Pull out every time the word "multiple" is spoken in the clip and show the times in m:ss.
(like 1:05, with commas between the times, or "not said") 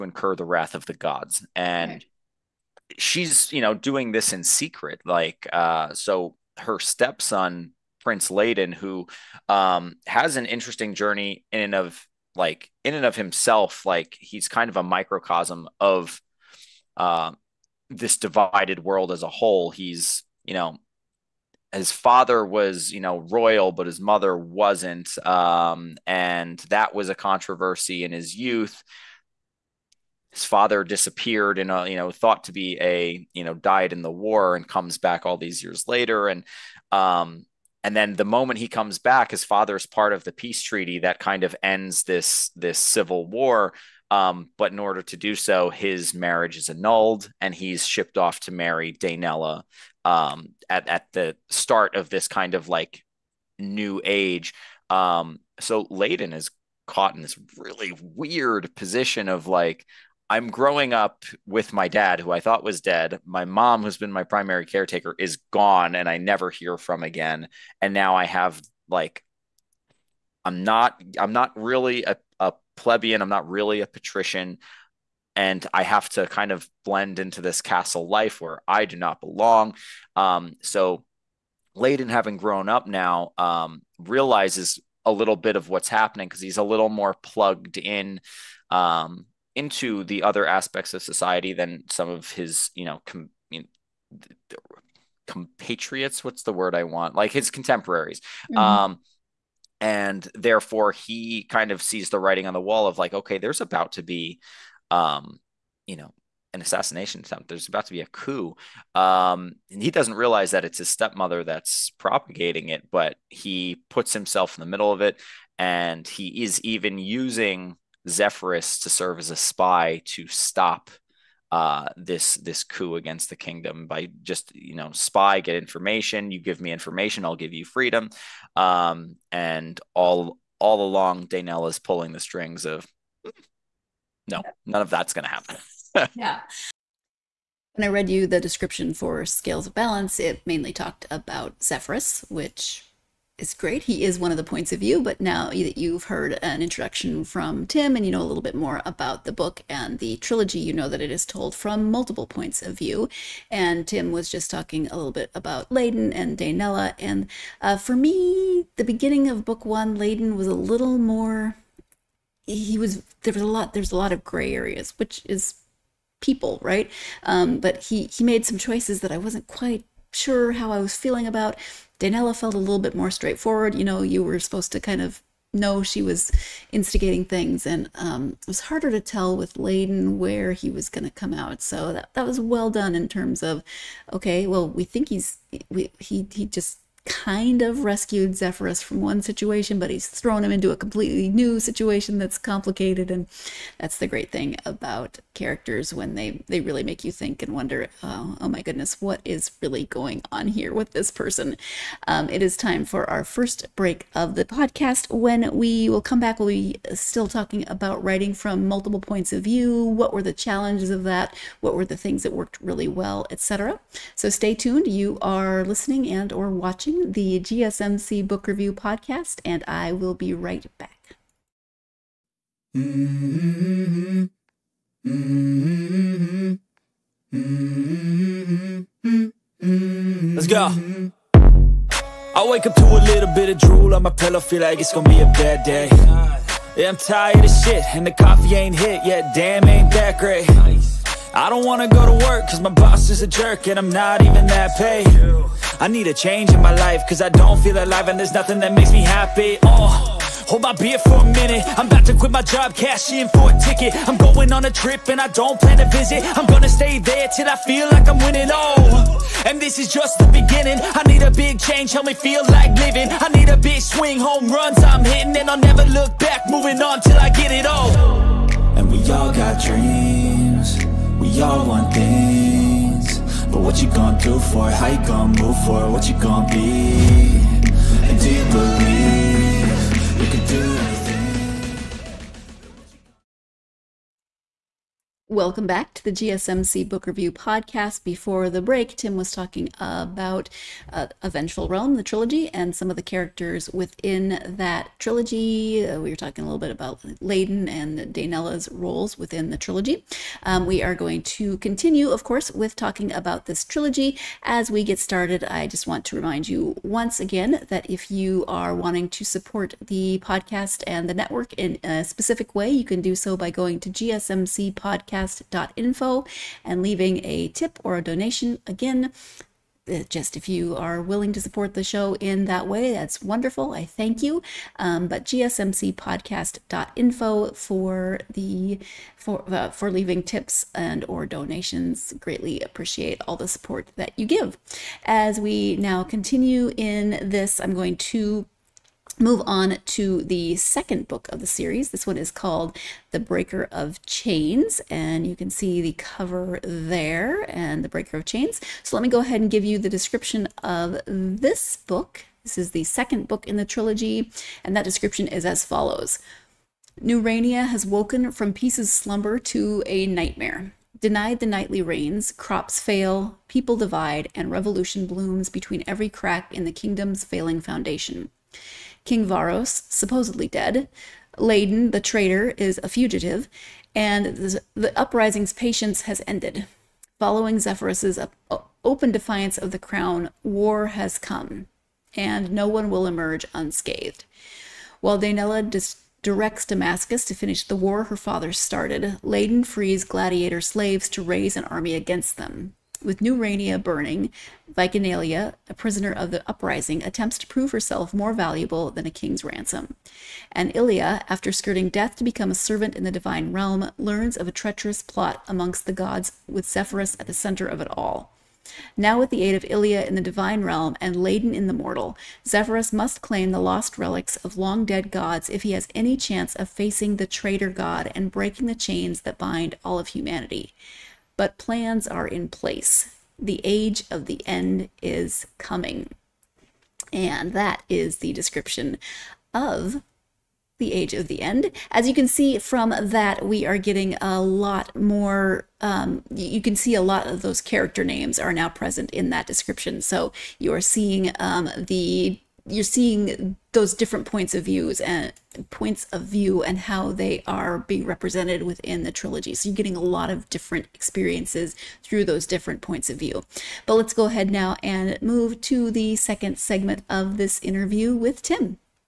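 2:31, 3:28.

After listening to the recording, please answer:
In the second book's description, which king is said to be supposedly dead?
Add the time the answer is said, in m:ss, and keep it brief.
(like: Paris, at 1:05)
King Varos, at 6:09.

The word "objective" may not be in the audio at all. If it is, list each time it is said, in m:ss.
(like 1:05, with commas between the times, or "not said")
not said.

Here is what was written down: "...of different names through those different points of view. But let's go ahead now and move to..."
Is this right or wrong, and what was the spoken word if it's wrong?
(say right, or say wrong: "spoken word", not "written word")
wrong: "experiences", not "names".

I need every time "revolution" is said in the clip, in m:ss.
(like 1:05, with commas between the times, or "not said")
6:04.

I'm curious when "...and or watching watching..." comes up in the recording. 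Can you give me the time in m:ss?
3:36.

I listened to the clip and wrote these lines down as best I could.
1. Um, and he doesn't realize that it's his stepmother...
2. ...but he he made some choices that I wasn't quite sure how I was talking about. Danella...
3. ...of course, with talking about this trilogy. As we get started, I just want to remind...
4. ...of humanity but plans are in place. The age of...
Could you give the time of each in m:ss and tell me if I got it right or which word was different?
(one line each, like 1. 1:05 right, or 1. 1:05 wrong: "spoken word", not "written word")
1. 1:48 right
2. 2:47 wrong: "feeling", not "talking"
3. 5:02 right
4. 7:00 right.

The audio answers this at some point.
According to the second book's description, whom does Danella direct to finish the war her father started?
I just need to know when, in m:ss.
6:26.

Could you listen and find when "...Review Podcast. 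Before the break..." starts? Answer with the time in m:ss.
4:47.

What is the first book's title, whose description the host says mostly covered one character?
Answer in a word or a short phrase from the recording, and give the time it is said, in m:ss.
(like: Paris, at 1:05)
Scales of Balance, at 2:19.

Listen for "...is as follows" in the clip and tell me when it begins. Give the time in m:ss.
5:55.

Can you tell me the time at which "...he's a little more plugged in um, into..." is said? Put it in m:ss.
1:26.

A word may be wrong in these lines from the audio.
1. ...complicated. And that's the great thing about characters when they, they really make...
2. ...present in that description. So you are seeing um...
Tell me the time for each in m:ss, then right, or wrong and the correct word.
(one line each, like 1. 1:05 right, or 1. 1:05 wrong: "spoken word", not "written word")
1. 3:12 right
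2. 7:18 right.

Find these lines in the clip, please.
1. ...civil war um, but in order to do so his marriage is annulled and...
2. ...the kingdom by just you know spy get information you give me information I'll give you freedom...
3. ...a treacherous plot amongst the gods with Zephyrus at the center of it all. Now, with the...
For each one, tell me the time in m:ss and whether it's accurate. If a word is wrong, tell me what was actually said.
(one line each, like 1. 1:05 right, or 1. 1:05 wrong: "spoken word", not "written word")
1. 0:42 right
2. 2:03 right
3. 6:44 right.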